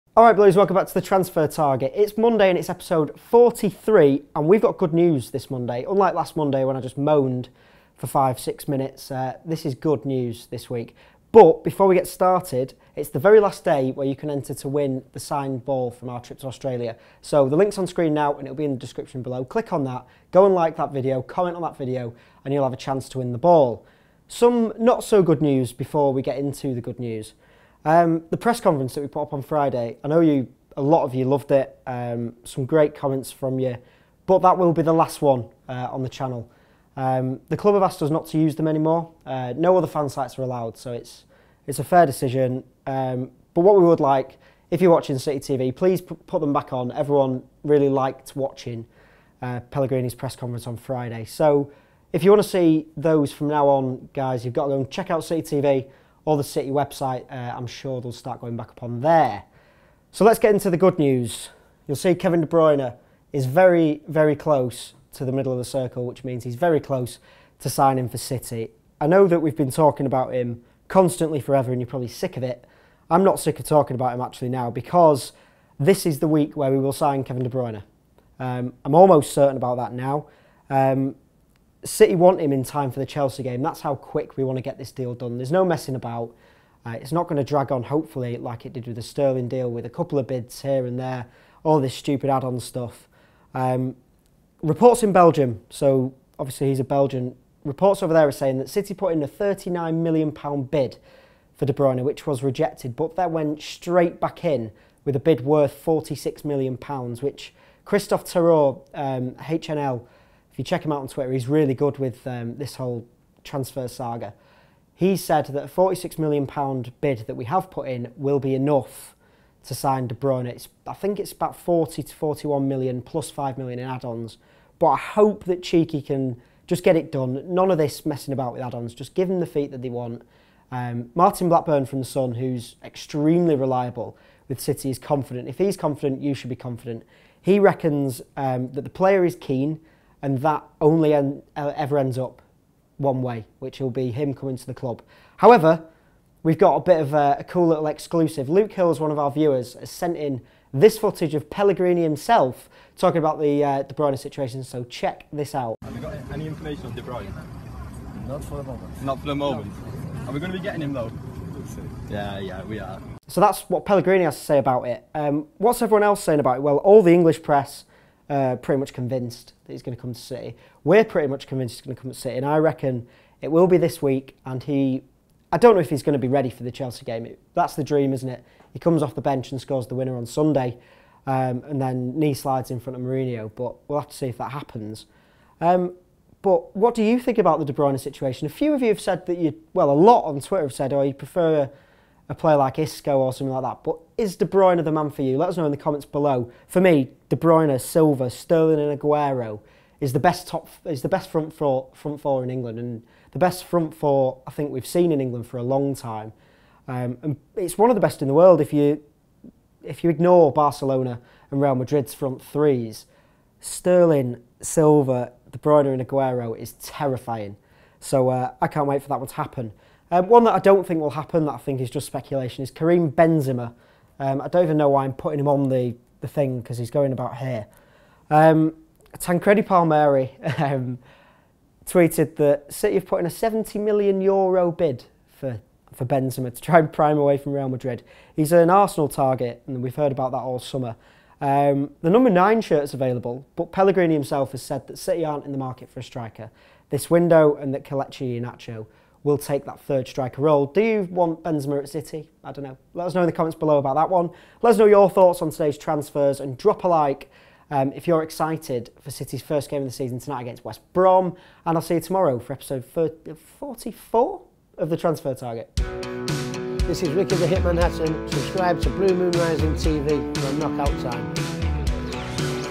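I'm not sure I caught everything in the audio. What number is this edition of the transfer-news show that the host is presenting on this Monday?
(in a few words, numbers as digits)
43.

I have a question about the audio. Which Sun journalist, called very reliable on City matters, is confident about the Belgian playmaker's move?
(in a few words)
Martin Blackburn.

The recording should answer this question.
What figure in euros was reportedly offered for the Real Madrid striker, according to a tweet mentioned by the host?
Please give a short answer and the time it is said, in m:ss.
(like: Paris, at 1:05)
70 million euros, at 3:53.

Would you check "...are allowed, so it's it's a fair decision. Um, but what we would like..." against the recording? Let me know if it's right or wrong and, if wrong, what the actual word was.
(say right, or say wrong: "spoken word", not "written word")
right.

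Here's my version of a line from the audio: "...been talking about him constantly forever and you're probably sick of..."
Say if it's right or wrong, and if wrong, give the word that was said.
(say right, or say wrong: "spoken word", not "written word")
right.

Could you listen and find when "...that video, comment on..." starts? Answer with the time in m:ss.
0:20.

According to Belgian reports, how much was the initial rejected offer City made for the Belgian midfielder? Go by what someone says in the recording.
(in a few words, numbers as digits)
£39 million.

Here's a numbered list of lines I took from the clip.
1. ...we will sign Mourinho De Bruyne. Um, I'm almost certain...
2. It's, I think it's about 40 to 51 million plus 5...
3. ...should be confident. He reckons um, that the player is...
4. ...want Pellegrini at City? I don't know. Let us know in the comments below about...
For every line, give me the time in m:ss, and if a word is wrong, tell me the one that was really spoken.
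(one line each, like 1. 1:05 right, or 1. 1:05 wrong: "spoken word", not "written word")
1. 1:16 wrong: "Kevin", not "Mourinho"
2. 2:00 wrong: "41", not "51"
3. 2:16 right
4. 4:11 wrong: "Benzema", not "Pellegrini".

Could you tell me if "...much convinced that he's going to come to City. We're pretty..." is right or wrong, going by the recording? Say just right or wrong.
right.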